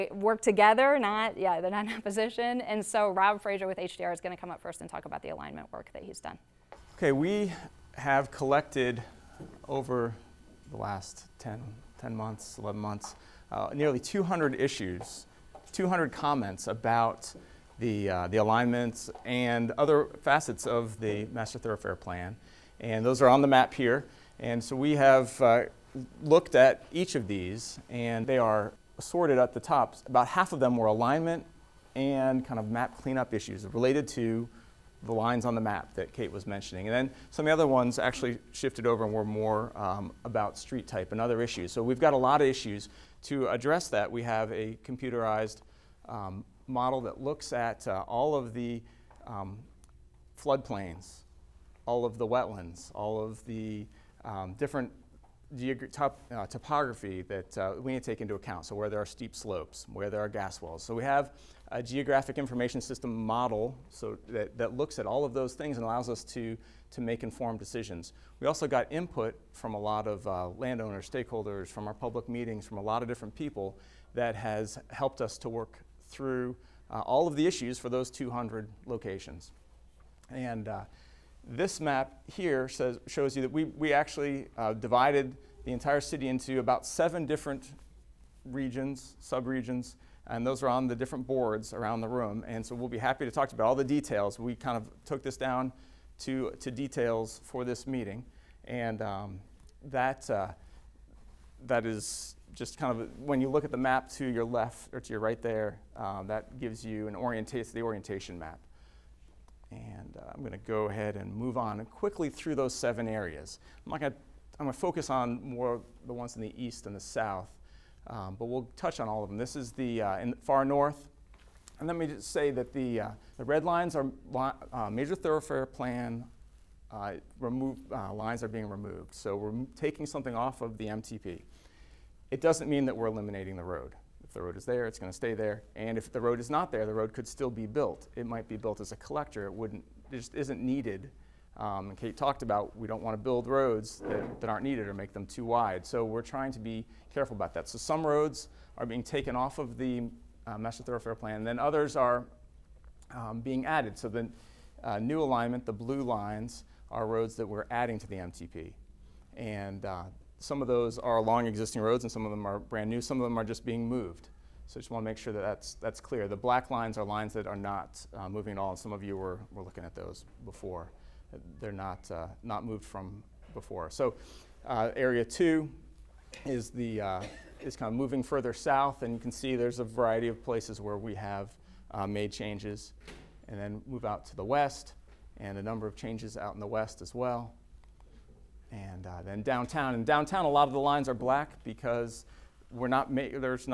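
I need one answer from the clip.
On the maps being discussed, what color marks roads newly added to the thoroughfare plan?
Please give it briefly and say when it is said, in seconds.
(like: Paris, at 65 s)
Blue, at 155 s.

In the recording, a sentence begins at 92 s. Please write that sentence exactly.
And so we'll be happy to talk about all the details.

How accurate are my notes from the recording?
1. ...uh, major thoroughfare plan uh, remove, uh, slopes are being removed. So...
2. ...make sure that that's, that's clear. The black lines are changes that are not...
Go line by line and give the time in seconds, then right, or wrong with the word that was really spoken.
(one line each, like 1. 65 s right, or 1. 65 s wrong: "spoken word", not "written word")
1. 124 s wrong: "lines", not "slopes"
2. 165 s wrong: "lines", not "changes".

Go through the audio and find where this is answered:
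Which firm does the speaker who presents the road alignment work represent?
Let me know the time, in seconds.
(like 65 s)
3 s.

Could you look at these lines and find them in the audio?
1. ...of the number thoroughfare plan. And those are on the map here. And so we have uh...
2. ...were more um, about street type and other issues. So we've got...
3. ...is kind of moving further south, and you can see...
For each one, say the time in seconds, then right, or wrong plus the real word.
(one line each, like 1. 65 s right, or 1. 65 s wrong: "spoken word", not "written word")
1. 20 s wrong: "master", not "number"
2. 39 s right
3. 177 s right.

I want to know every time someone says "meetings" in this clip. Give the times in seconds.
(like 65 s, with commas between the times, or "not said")
72 s, 97 s.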